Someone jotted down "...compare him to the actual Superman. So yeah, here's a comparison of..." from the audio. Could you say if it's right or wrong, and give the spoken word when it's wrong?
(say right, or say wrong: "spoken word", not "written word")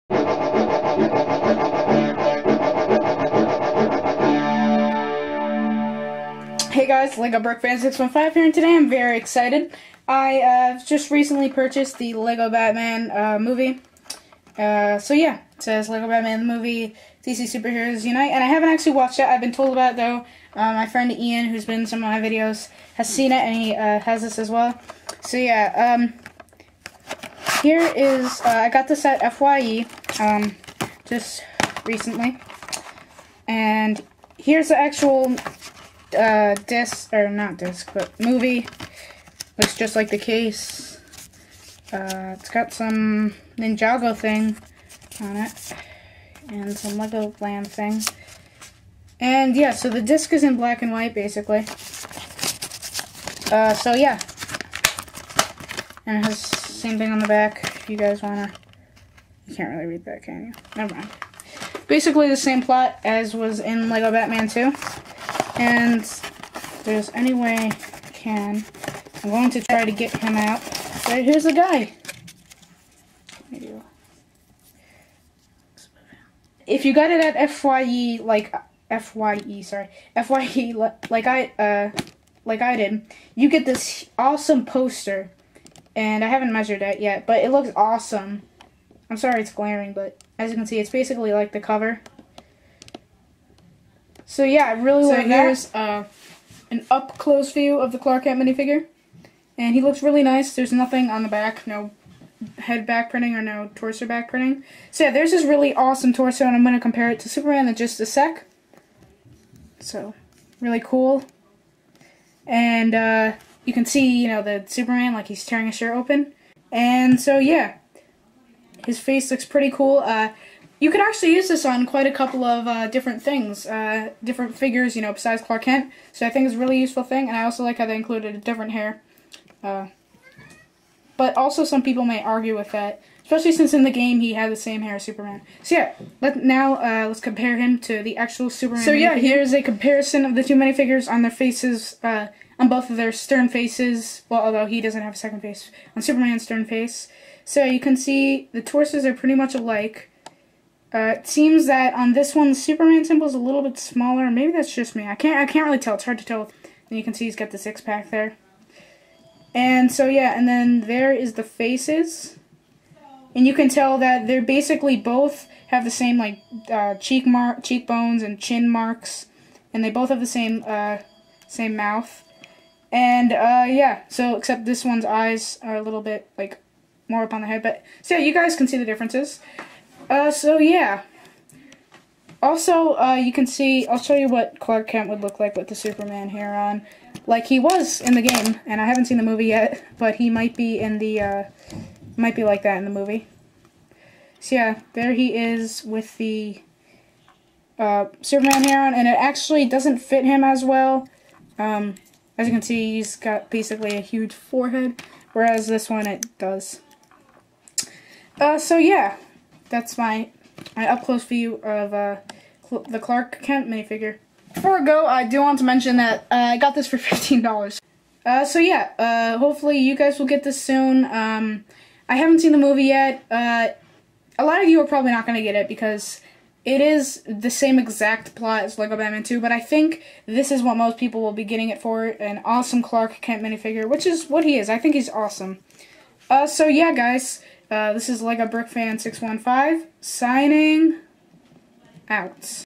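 right.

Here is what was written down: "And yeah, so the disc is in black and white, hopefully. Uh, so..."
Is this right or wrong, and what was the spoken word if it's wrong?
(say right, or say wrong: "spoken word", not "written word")
wrong: "basically", not "hopefully".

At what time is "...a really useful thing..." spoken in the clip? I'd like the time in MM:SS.
02:06.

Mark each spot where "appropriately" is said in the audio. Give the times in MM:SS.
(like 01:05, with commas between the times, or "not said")
not said.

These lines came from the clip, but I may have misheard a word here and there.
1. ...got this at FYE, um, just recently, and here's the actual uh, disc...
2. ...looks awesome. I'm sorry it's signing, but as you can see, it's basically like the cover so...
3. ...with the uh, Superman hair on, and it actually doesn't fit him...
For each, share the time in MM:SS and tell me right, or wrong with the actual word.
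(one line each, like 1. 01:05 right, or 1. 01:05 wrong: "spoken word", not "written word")
1. 00:28 right
2. 01:27 wrong: "glaring", not "signing"
3. 03:15 right.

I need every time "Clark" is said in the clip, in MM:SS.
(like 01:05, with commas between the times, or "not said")
01:37, 02:05, 03:04, 03:32, 03:52.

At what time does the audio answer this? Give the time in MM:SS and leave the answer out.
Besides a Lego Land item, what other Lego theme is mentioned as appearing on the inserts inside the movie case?
00:43.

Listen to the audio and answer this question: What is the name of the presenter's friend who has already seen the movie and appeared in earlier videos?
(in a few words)
Ian.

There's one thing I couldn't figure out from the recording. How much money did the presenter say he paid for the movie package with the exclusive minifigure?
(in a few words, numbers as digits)
$15.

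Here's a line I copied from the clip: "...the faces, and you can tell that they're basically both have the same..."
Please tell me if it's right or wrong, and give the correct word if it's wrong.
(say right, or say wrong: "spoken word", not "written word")
right.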